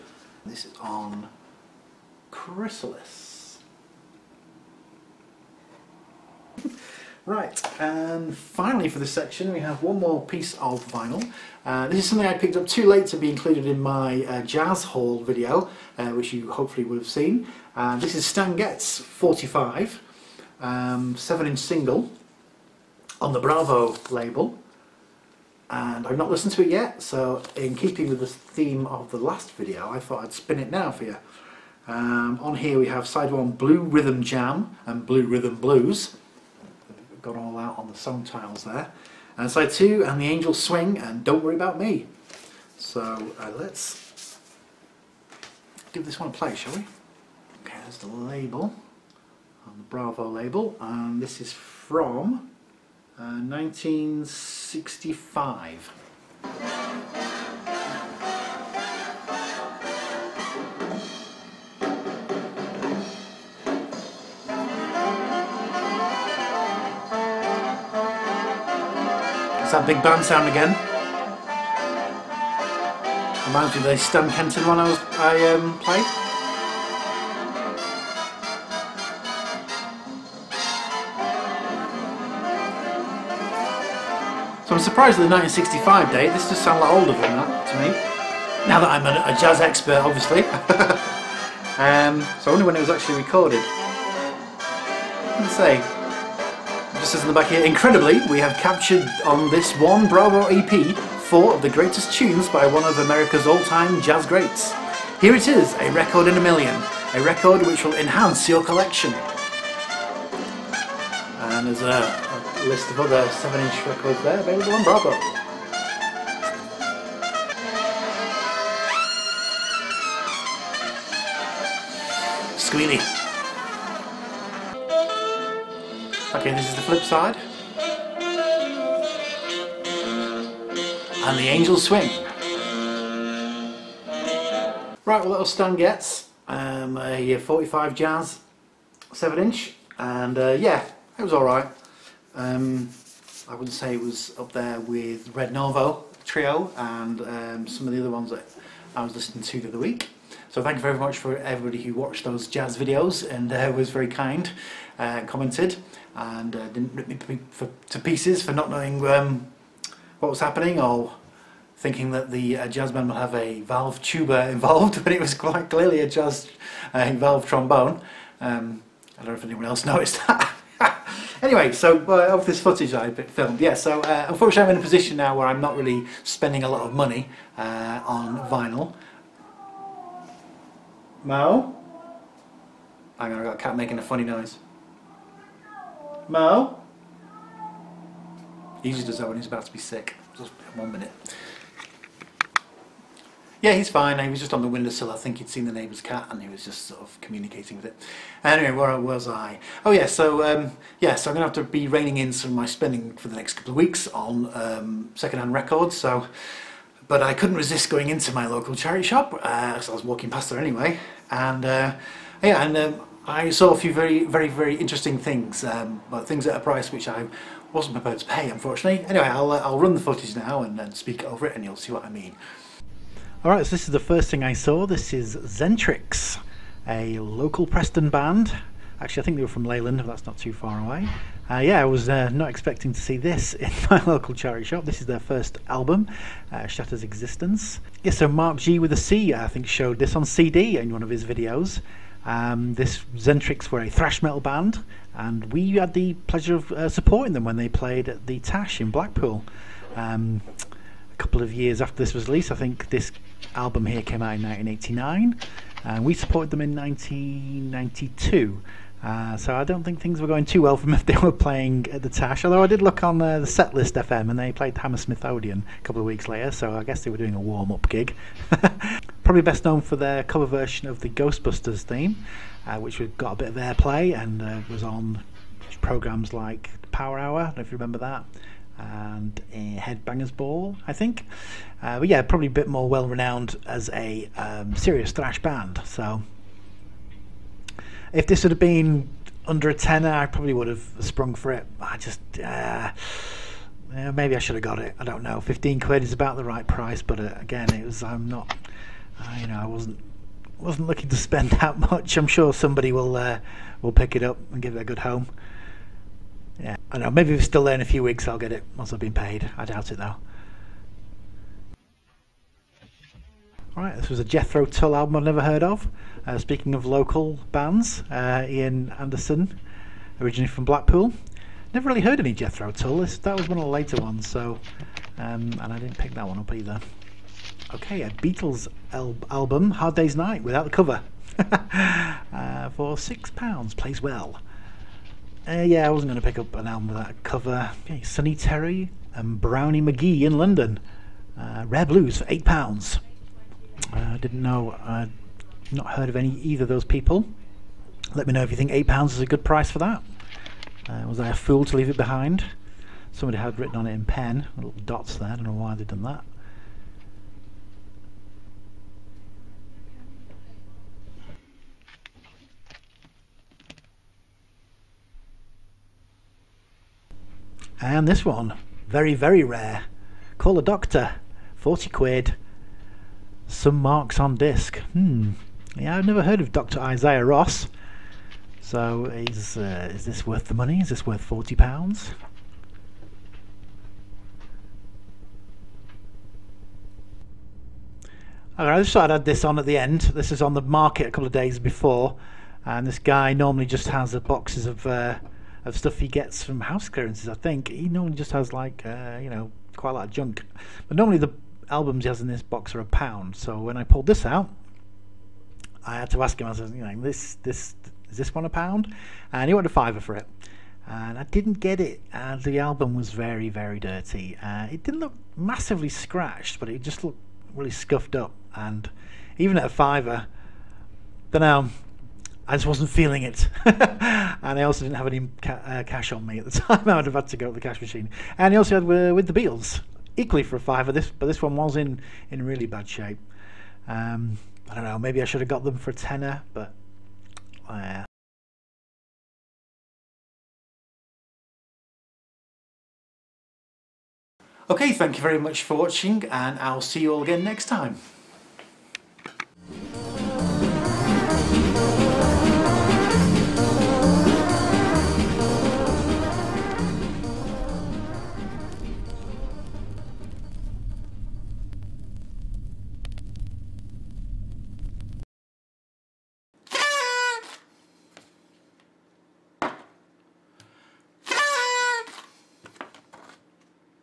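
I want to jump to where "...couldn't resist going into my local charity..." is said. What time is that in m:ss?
3:27.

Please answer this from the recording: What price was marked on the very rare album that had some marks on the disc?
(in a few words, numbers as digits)
£40.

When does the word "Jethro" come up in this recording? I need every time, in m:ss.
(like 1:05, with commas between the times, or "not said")
5:14, 5:22.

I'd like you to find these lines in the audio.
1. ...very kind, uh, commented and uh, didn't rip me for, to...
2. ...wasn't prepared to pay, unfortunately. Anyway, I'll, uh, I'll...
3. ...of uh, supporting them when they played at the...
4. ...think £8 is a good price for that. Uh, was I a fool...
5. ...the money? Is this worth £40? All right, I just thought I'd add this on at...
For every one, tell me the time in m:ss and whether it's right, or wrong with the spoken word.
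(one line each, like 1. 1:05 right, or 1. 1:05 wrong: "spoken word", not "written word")
1. 2:33 right
2. 3:37 right
3. 4:06 right
4. 5:48 right
5. 6:20 right.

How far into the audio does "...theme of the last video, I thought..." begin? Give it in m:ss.
0:28.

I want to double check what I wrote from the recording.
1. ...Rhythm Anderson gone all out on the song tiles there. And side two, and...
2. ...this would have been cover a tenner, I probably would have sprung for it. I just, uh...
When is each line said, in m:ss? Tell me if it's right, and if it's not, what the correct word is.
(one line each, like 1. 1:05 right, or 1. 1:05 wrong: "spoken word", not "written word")
1. 0:35 wrong: "Blues", not "Anderson"
2. 4:48 wrong: "under", not "cover".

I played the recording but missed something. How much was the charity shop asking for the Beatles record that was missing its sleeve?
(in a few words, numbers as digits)
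£6.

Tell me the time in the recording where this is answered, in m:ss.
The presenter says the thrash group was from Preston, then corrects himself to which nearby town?
3:49.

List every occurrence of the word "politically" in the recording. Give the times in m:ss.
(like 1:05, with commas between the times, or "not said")
not said.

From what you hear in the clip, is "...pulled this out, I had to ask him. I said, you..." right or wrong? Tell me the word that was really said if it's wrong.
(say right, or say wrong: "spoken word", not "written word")
right.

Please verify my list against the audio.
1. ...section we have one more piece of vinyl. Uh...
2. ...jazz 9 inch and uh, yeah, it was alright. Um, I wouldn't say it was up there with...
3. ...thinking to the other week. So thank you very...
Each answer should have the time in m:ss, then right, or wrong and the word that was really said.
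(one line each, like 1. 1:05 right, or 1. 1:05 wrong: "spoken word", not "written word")
1. 0:09 right
2. 2:17 wrong: "7", not "9"
3. 2:29 wrong: "listening", not "thinking".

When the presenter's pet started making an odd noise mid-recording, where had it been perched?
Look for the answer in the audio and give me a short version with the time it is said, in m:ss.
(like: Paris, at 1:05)
windowsill, at 3:14.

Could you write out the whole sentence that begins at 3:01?
Mao, Hang on, i got a cat making a funny noise.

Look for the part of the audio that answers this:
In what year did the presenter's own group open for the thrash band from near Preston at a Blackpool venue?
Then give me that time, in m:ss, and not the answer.
4:16.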